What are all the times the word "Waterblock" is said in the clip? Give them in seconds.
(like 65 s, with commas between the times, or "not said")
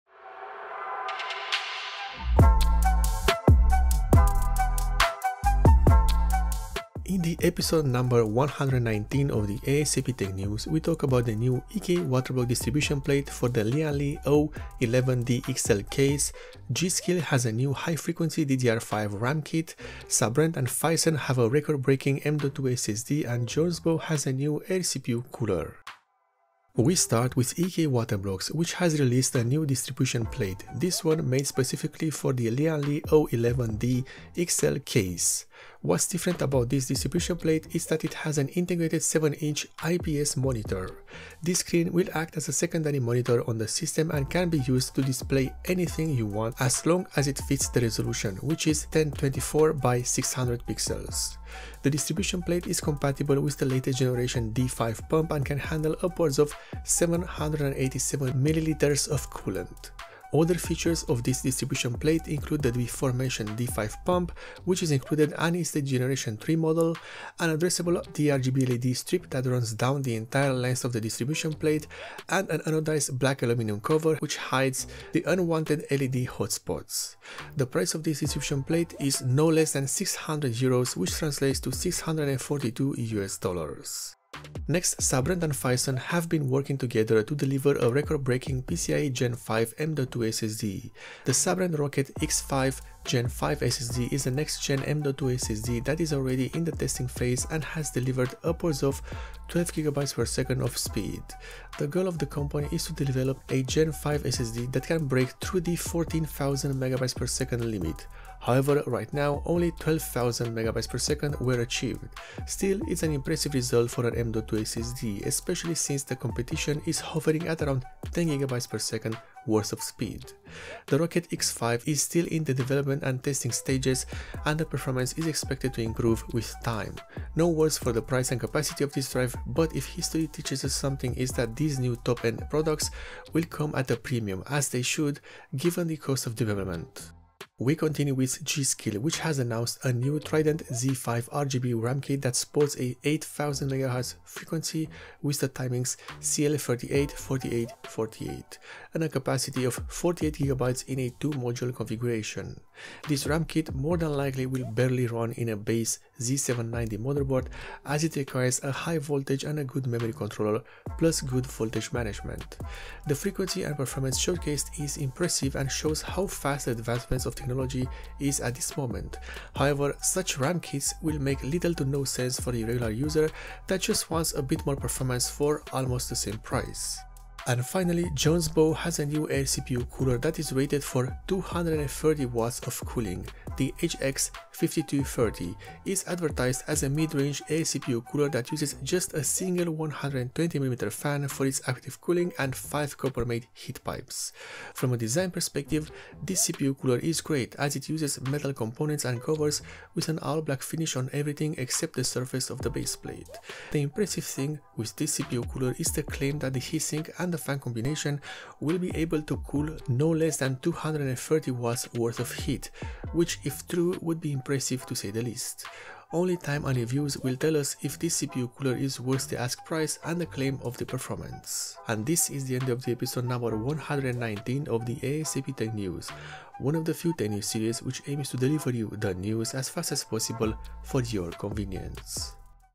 12 s, 27 s.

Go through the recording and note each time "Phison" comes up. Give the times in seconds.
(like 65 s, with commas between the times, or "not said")
20 s, 85 s.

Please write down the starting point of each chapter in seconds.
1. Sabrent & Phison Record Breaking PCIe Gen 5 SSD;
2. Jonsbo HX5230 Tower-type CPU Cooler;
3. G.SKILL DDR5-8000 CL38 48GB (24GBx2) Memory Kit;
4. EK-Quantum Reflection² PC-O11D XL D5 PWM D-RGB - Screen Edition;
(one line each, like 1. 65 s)
1. 85 s
2. 178 s
3. 138 s
4. 28 s.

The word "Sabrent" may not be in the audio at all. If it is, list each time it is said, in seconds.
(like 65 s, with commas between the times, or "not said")
20 s, 85 s, 91 s.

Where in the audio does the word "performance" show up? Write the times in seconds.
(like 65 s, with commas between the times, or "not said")
124 s, 163 s, 174 s, 220 s.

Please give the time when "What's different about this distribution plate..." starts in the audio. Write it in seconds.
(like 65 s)
35 s.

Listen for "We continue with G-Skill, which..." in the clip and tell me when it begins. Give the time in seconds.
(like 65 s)
137 s.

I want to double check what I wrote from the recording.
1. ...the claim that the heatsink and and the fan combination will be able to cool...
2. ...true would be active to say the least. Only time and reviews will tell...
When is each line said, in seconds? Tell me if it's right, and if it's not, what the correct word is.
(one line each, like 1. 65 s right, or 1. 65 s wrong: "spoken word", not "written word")
1. 205 s right
2. 213 s wrong: "impressive", not "active".